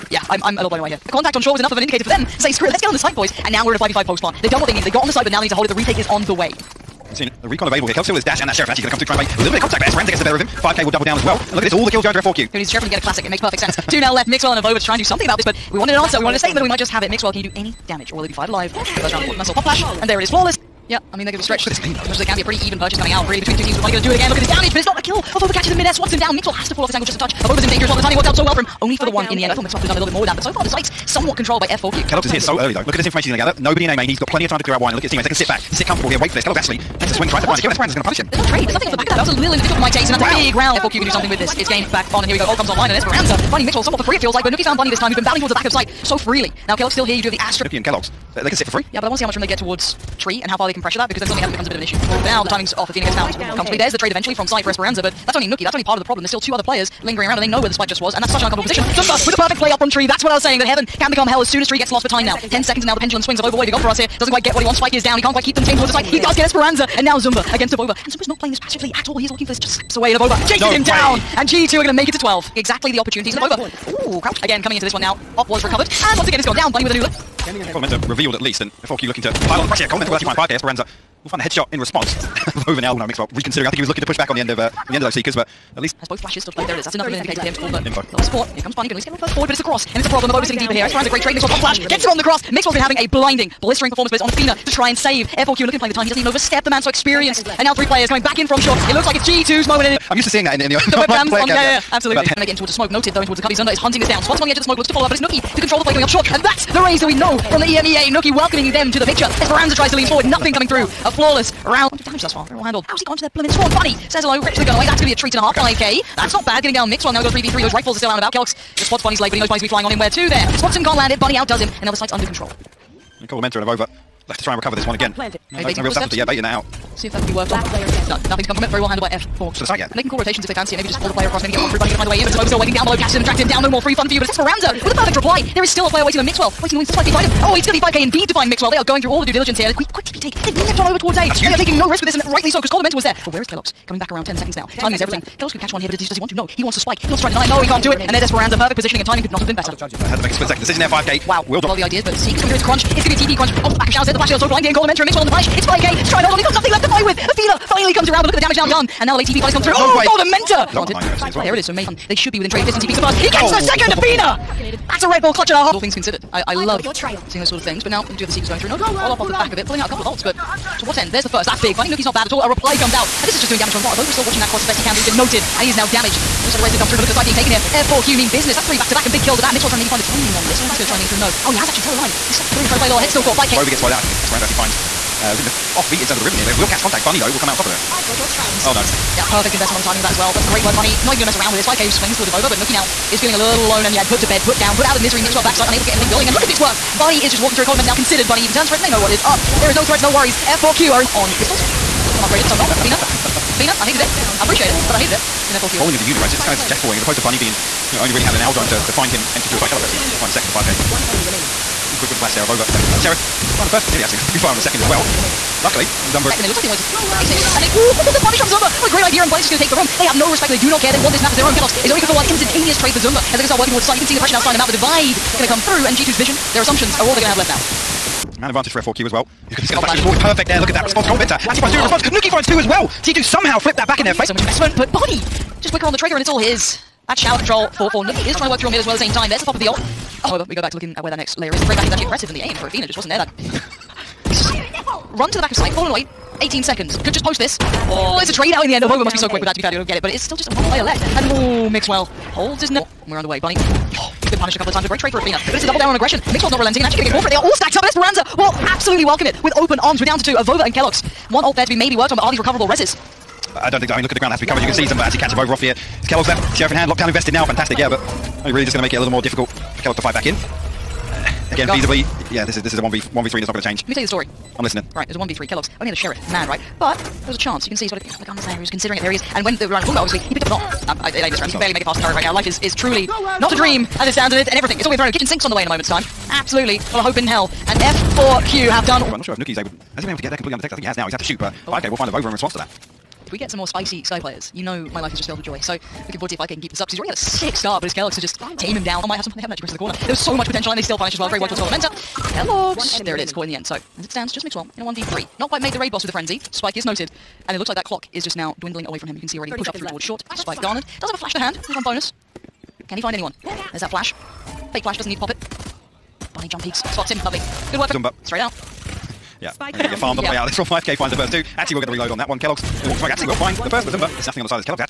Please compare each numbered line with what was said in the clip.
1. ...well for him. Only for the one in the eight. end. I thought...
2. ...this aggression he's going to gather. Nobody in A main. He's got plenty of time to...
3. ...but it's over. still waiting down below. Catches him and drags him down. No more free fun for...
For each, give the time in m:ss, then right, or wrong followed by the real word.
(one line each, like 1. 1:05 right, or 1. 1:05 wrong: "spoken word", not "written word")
1. 0:28 right
2. 0:32 wrong: "information", not "aggression"
3. 2:12 right.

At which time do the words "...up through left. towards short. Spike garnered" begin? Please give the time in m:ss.
5:09.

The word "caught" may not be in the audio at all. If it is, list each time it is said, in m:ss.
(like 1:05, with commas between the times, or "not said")
3:03, 5:03.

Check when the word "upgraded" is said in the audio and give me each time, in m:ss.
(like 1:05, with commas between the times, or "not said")
3:22.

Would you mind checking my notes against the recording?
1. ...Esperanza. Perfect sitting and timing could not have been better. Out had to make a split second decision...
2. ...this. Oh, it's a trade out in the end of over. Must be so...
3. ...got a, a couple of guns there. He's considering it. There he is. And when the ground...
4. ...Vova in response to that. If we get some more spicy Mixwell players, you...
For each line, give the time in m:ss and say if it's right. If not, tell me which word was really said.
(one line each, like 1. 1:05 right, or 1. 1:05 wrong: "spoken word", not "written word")
1. 2:28 wrong: "positioning", not "sitting"
2. 4:07 right
3. 4:37 wrong: "round", not "ground"
4. 4:52 wrong: "Skye", not "Mixwell".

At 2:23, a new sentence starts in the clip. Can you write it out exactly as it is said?
Coming back around 10 seconds now.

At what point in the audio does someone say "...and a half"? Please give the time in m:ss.
1:55.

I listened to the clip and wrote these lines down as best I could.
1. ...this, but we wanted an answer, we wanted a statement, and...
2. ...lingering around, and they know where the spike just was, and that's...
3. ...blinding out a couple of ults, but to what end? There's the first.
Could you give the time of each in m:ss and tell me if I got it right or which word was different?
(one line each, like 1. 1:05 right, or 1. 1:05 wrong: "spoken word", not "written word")
1. 0:15 right
2. 0:57 right
3. 2:49 wrong: "pulling", not "blinding".